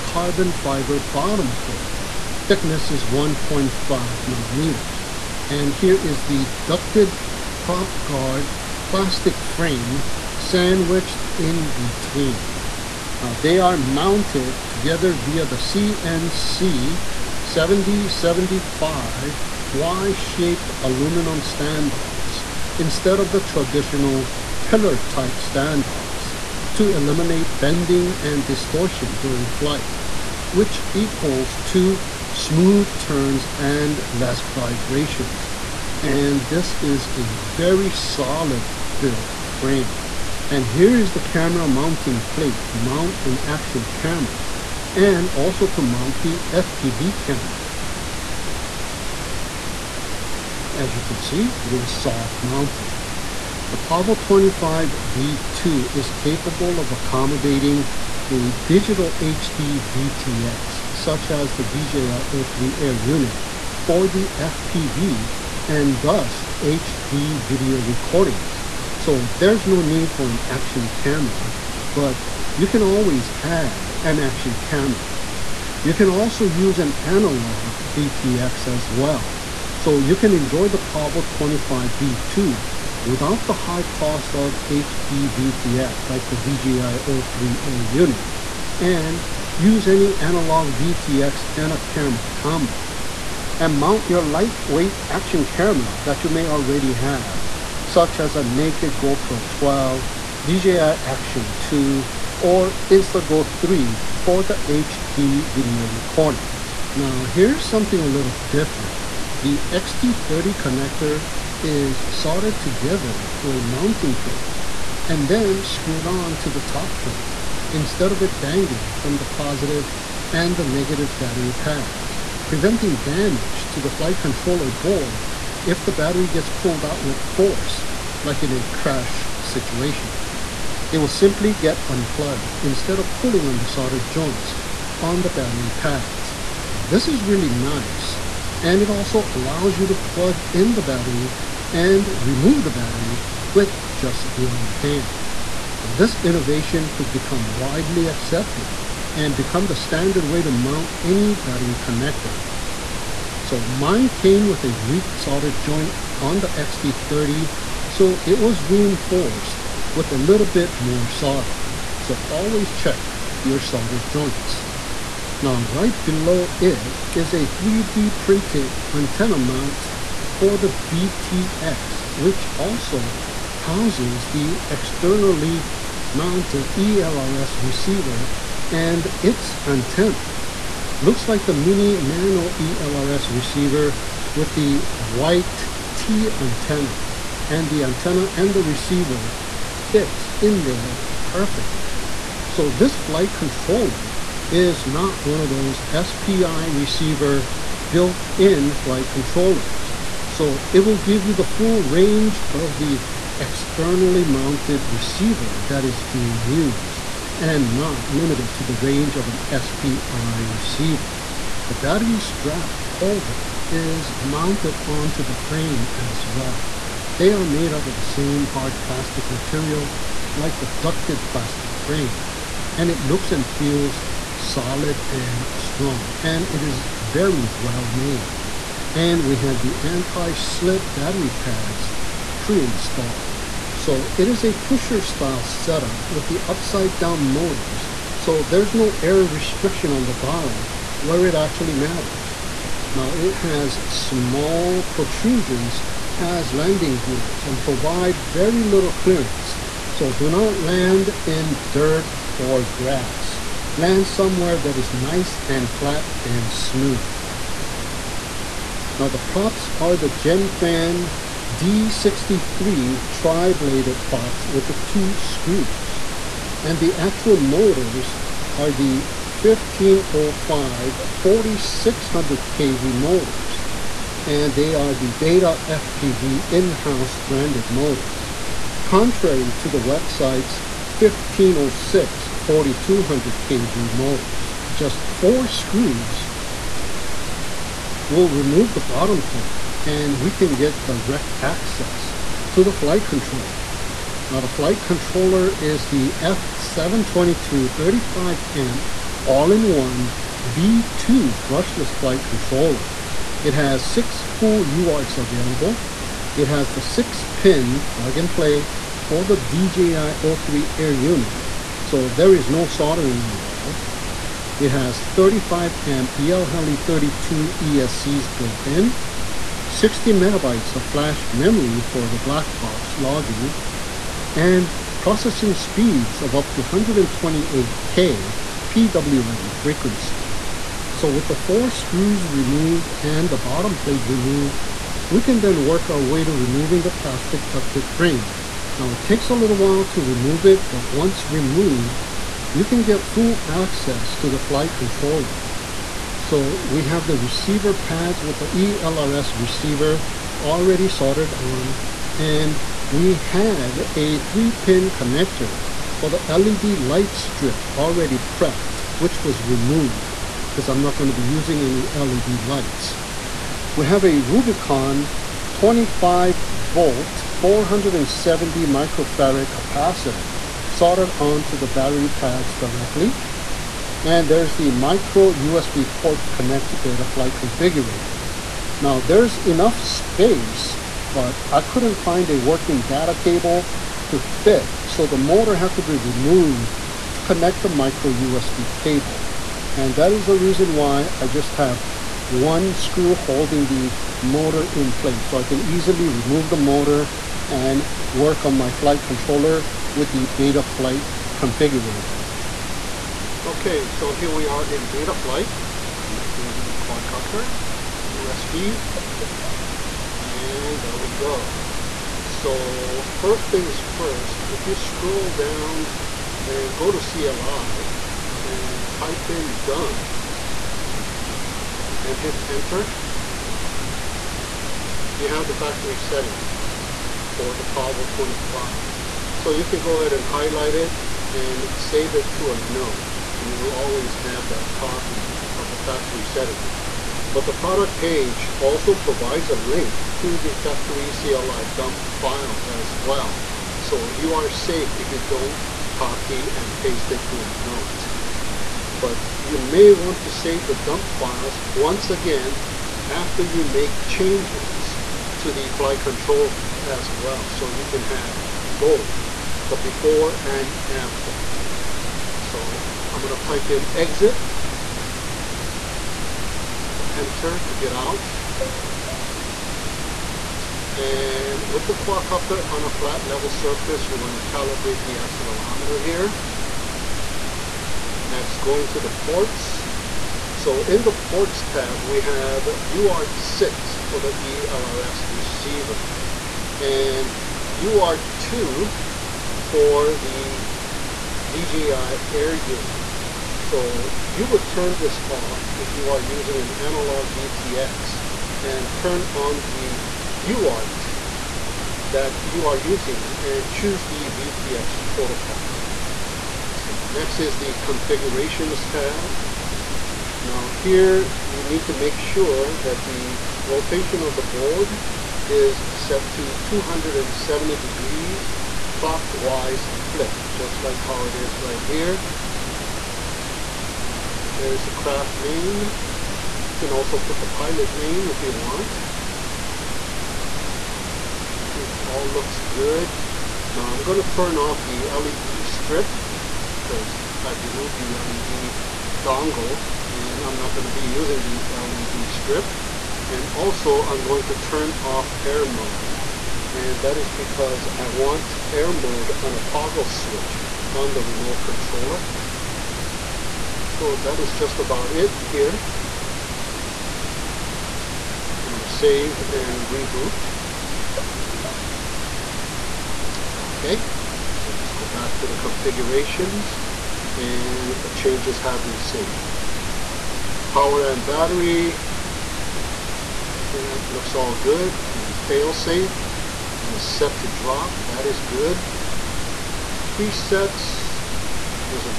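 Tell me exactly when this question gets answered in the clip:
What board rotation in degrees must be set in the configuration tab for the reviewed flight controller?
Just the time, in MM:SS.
08:36.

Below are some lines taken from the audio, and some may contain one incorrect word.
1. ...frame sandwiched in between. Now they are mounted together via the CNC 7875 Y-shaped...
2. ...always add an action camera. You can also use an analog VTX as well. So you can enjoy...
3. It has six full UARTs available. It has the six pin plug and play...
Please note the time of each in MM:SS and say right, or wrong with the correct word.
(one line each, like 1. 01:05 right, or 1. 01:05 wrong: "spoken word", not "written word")
1. 00:09 wrong: "7075", not "7875"
2. 01:12 right
3. 05:03 right.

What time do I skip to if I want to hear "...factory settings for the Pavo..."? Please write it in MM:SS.
07:05.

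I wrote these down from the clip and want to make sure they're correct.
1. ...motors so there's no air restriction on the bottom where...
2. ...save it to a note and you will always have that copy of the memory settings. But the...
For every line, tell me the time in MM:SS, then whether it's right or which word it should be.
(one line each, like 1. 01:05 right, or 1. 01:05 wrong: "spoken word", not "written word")
1. 03:57 right
2. 07:11 wrong: "factory", not "memory".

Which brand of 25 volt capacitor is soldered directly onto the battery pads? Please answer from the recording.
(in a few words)
Rubycon.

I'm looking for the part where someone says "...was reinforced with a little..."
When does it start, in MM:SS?
02:38.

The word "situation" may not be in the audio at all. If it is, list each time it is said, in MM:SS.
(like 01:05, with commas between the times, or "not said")
02:09.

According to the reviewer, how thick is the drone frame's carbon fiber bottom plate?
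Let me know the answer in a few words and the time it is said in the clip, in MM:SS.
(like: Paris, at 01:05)
1.5 millimeters, at 00:03.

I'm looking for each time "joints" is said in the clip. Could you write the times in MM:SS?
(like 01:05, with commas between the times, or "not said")
02:14, 02:35, 02:43.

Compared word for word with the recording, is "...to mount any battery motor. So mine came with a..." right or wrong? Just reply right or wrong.
wrong.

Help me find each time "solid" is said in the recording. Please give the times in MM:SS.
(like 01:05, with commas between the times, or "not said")
00:37, 03:44.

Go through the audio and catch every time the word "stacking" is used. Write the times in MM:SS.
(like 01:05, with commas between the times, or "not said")
not said.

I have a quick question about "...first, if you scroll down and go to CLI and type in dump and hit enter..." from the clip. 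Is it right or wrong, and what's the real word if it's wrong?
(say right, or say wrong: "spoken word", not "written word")
right.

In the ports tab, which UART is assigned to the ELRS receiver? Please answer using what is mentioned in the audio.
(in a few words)
UART6.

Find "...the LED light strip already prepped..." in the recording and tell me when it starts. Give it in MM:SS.
05:56.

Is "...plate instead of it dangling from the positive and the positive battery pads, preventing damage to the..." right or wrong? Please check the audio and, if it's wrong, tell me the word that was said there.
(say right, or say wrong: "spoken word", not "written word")
wrong: "negative", not "positive".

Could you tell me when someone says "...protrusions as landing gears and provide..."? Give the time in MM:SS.
04:04.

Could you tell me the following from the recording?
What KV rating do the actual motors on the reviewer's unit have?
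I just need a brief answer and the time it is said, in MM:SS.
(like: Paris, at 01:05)
4600 kV, at 04:31.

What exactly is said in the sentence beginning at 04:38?
Contrary to the website's 1506 4200 kV motors.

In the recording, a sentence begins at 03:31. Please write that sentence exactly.
The battery strap holder is mounted onto the frame as well.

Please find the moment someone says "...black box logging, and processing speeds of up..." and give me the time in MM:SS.
05:22.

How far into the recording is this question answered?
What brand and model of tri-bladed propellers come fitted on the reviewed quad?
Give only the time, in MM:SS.
04:20.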